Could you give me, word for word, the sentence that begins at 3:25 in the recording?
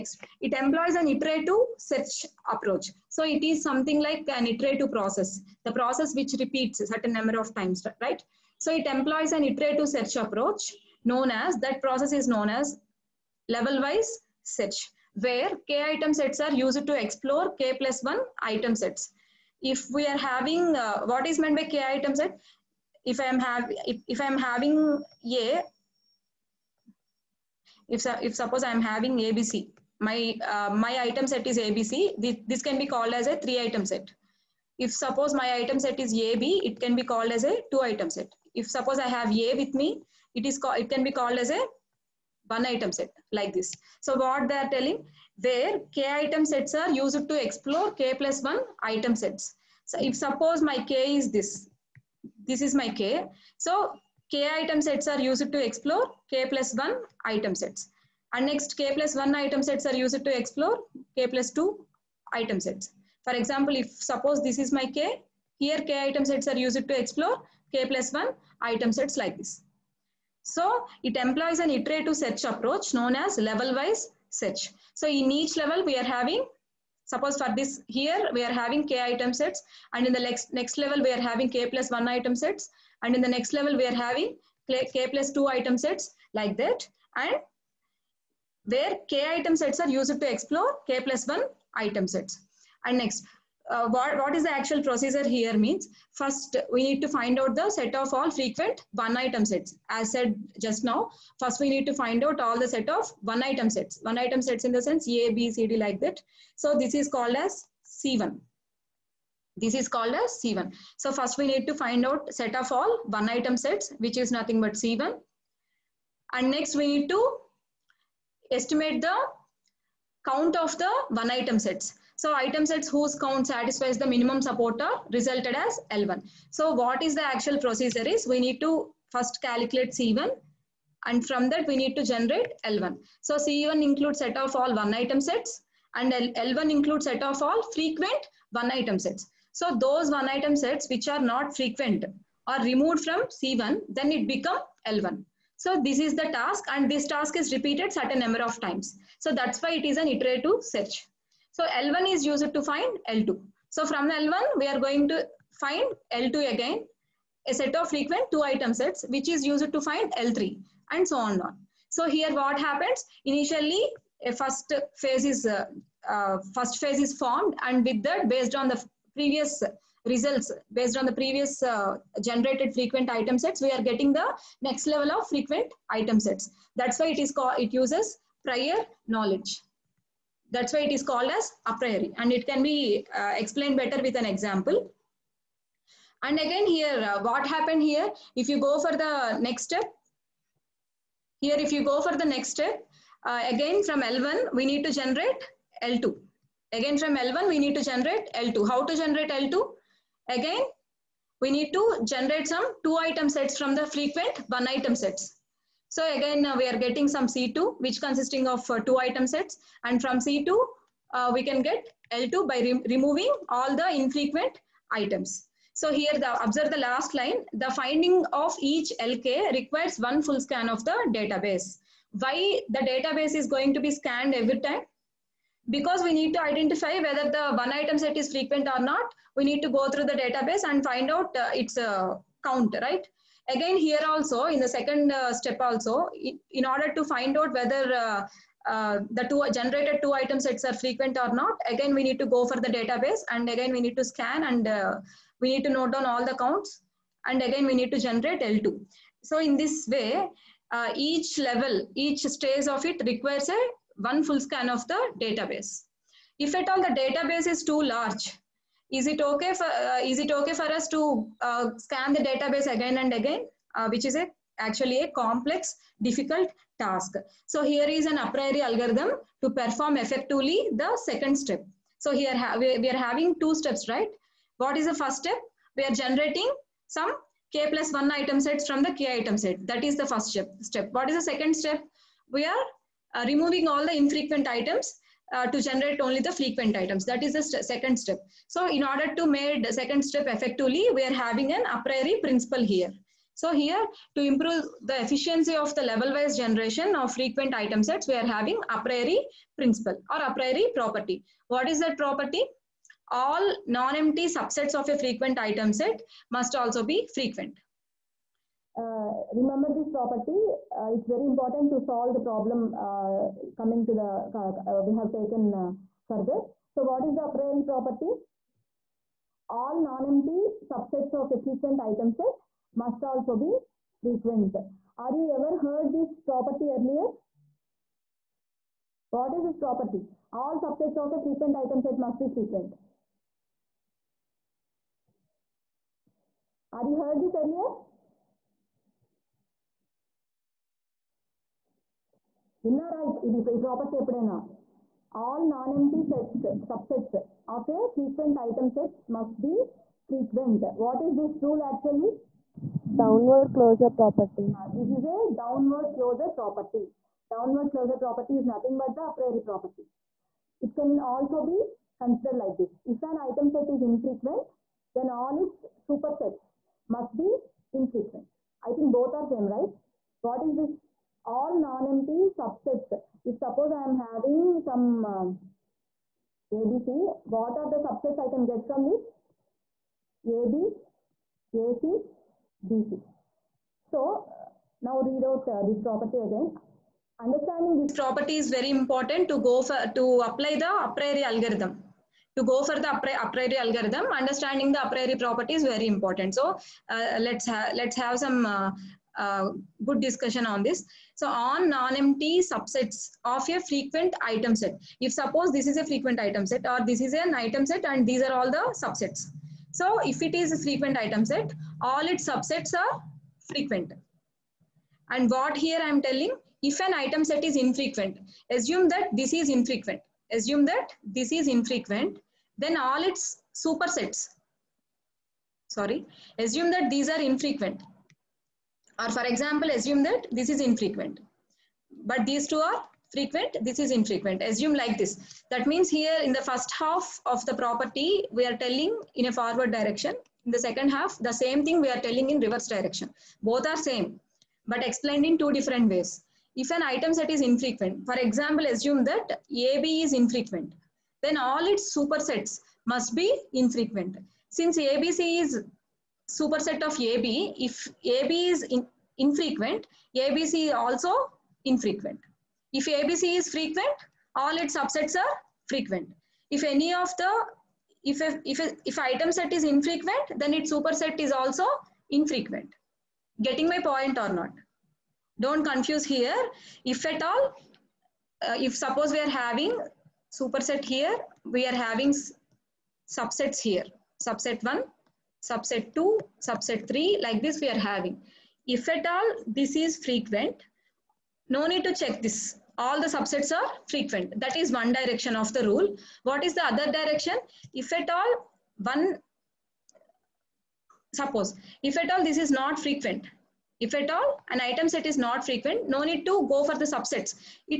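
So again, uh, we are getting some C2, which consisting of uh, two item sets.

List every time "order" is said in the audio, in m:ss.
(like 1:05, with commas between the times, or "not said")
3:56, 4:48.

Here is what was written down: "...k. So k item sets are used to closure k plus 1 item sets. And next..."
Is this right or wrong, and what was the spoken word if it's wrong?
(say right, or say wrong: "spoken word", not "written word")
wrong: "explore", not "closure".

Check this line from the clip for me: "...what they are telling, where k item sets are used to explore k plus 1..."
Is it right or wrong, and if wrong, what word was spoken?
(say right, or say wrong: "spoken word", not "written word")
right.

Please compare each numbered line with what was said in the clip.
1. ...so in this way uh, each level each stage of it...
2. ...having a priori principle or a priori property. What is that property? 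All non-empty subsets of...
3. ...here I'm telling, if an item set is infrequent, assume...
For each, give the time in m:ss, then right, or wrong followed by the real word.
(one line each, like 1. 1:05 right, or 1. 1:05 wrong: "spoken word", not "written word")
1. 4:09 right
2. 4:58 right
3. 6:55 right.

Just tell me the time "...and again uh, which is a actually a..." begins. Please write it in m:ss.
4:23.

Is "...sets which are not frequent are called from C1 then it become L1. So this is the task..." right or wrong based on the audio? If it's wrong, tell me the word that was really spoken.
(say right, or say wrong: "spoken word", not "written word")
wrong: "removed", not "called".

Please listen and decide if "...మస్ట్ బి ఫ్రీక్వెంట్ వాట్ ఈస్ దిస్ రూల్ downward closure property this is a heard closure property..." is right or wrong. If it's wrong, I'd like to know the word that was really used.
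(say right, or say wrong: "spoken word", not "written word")
wrong: "downward", not "heard".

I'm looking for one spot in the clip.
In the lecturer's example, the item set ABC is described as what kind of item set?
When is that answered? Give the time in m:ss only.
0:33.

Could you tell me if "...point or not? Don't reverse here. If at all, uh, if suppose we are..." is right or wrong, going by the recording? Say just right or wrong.
wrong.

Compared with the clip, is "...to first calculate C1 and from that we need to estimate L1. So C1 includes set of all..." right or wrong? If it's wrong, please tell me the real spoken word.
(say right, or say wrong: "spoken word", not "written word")
wrong: "generate", not "estimate".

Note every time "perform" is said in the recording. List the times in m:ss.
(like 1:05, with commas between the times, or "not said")
4:29.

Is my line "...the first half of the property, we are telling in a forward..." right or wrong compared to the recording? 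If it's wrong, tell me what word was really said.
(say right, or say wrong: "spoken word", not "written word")
right.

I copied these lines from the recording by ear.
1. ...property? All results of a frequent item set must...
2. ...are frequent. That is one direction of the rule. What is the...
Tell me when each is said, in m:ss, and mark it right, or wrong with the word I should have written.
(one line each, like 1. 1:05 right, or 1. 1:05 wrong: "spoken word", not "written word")
1. 5:29 wrong: "subsets", not "results"
2. 8:13 right.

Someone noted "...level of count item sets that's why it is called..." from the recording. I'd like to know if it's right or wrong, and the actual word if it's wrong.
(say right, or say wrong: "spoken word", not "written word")
wrong: "frequent", not "count".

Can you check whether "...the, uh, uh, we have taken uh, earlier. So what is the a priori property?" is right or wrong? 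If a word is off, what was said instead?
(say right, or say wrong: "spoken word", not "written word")
wrong: "further", not "earlier".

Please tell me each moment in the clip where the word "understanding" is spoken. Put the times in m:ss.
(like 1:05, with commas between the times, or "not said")
6:27, 6:34.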